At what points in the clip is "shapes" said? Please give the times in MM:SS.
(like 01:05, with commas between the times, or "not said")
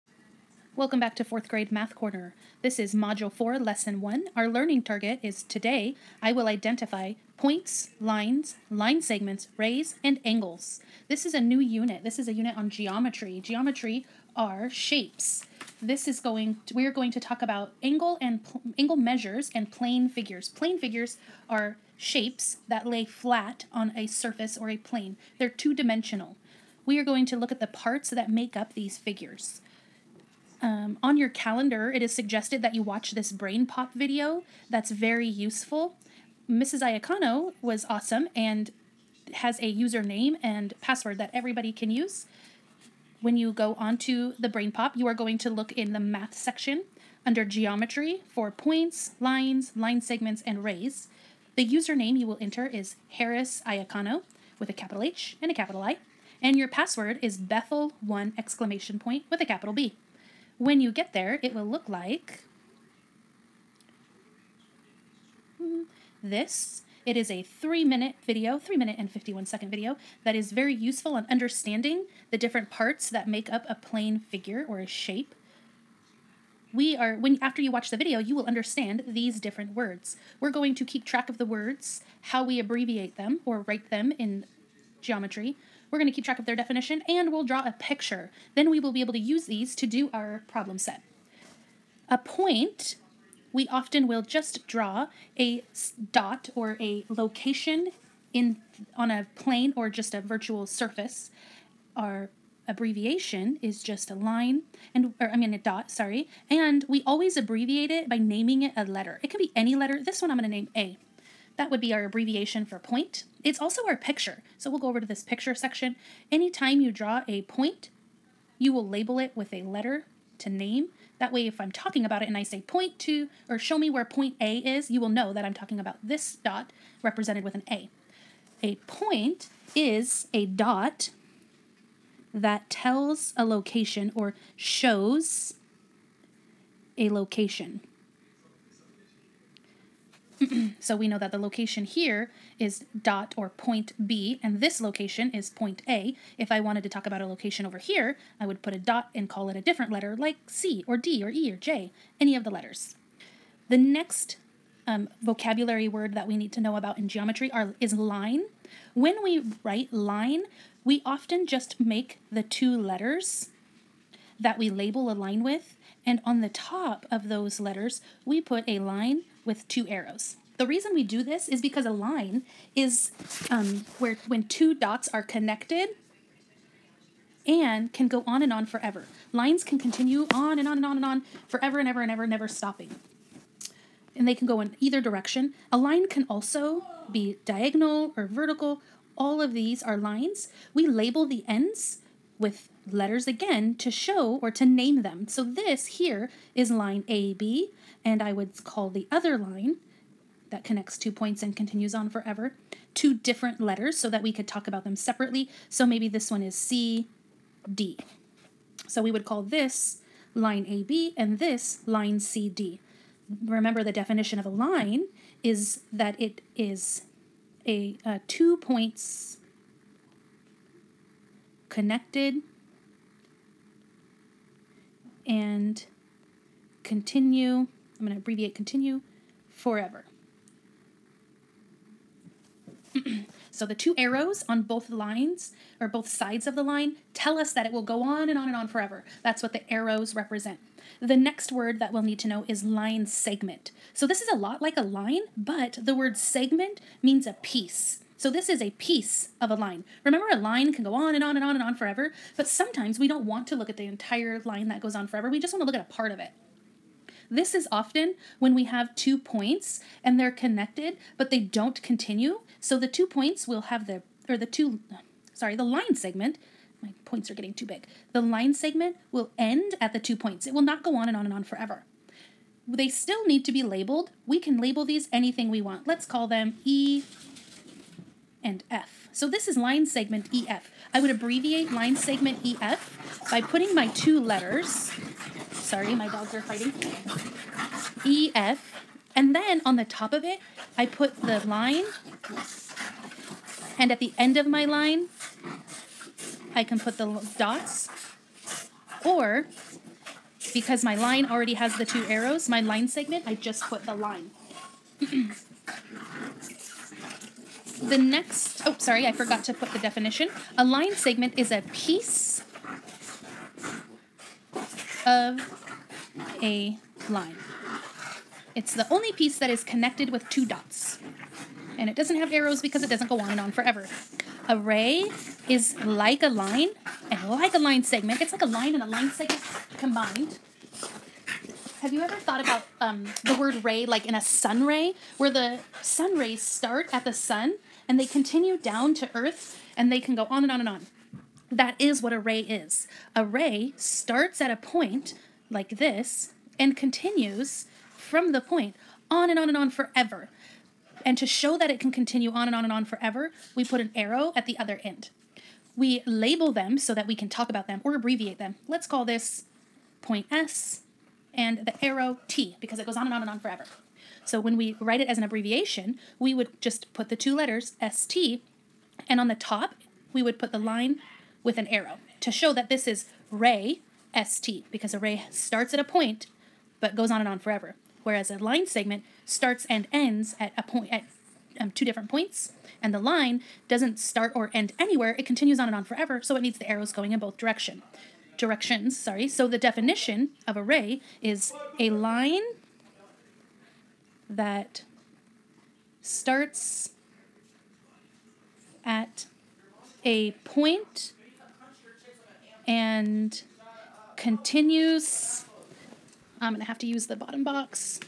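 00:14, 00:21, 01:14.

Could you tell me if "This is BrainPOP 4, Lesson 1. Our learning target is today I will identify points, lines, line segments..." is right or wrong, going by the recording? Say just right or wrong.
wrong.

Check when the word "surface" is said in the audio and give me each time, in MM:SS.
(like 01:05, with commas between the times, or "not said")
00:24, 01:40.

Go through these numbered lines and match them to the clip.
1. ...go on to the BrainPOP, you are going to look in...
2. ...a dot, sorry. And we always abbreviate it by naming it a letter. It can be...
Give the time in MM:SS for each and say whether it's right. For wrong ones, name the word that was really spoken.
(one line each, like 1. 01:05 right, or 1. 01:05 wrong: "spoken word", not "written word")
1. 00:43 right
2. 01:45 right.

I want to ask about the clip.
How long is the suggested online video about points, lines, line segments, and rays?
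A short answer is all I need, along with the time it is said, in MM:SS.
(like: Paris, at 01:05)
3 minutes 51 seconds, at 01:08.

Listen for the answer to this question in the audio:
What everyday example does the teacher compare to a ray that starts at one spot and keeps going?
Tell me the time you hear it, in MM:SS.
05:34.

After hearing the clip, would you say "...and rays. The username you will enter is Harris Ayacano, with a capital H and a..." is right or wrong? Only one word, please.
right.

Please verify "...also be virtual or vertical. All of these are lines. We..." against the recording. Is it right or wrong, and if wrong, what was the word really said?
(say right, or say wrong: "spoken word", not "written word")
wrong: "diagonal", not "virtual".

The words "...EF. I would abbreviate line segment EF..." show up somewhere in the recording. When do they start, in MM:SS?
04:40.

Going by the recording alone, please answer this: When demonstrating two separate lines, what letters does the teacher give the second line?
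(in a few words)
CD.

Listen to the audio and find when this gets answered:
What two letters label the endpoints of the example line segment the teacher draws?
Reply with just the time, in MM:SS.
04:36.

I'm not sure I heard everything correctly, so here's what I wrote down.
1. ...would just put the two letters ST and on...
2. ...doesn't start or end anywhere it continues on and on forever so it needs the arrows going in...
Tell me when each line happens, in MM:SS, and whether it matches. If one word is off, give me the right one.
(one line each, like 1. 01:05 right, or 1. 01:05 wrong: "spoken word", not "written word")
1. 06:06 right
2. 06:23 right.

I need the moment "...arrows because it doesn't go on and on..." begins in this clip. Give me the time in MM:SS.
05:22.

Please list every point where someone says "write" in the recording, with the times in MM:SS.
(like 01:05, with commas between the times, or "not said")
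01:23, 02:39, 06:04.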